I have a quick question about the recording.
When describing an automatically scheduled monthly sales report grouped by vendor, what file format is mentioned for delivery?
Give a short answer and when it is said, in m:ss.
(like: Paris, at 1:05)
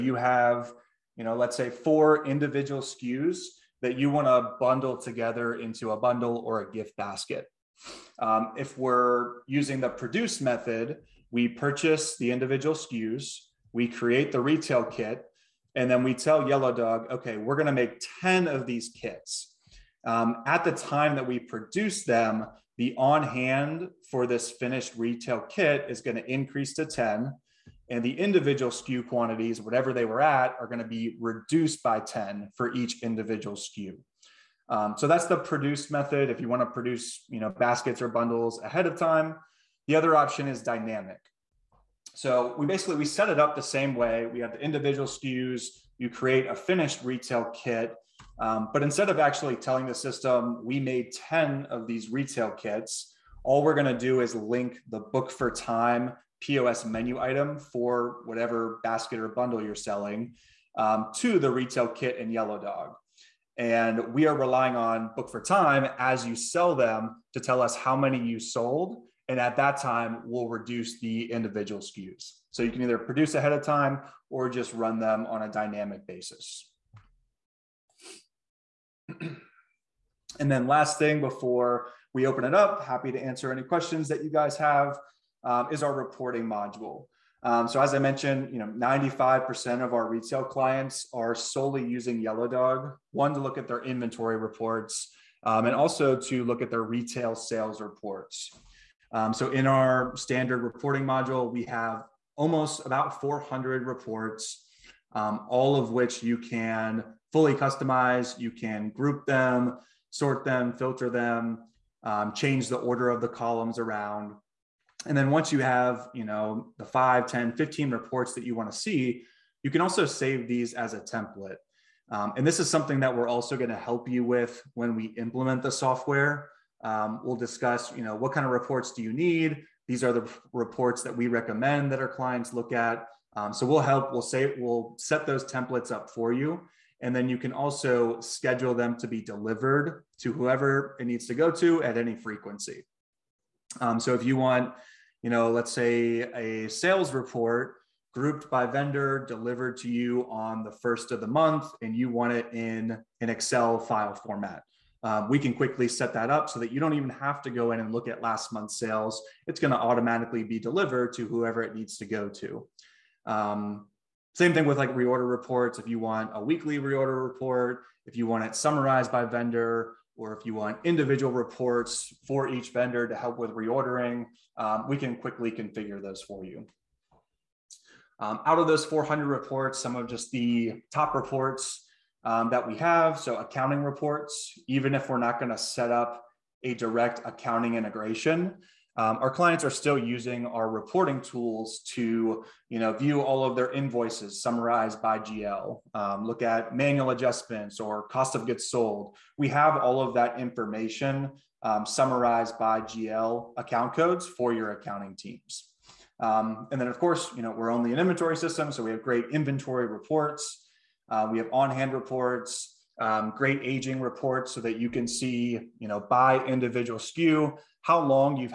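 Excel, at 2:33.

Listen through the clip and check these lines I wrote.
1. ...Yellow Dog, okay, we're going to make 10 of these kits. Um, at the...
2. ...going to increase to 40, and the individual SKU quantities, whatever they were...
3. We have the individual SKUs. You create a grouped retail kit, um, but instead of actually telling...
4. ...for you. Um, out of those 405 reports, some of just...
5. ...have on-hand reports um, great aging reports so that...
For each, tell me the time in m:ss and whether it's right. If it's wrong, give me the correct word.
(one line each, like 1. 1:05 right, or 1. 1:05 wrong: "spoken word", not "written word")
1. 0:16 right
2. 0:26 wrong: "10", not "40"
3. 0:44 wrong: "finished", not "grouped"
4. 2:56 wrong: "400", not "405"
5. 3:31 right.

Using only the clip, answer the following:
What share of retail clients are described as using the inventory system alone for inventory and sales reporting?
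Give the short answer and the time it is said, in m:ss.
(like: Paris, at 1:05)
95%, at 1:28.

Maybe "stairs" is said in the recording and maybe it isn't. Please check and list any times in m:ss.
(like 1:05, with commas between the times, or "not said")
not said.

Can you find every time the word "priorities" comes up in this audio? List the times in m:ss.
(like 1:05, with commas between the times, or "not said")
not said.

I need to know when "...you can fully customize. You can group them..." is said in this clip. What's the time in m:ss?
1:46.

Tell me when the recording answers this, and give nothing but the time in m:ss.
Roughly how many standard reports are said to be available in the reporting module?
1:42.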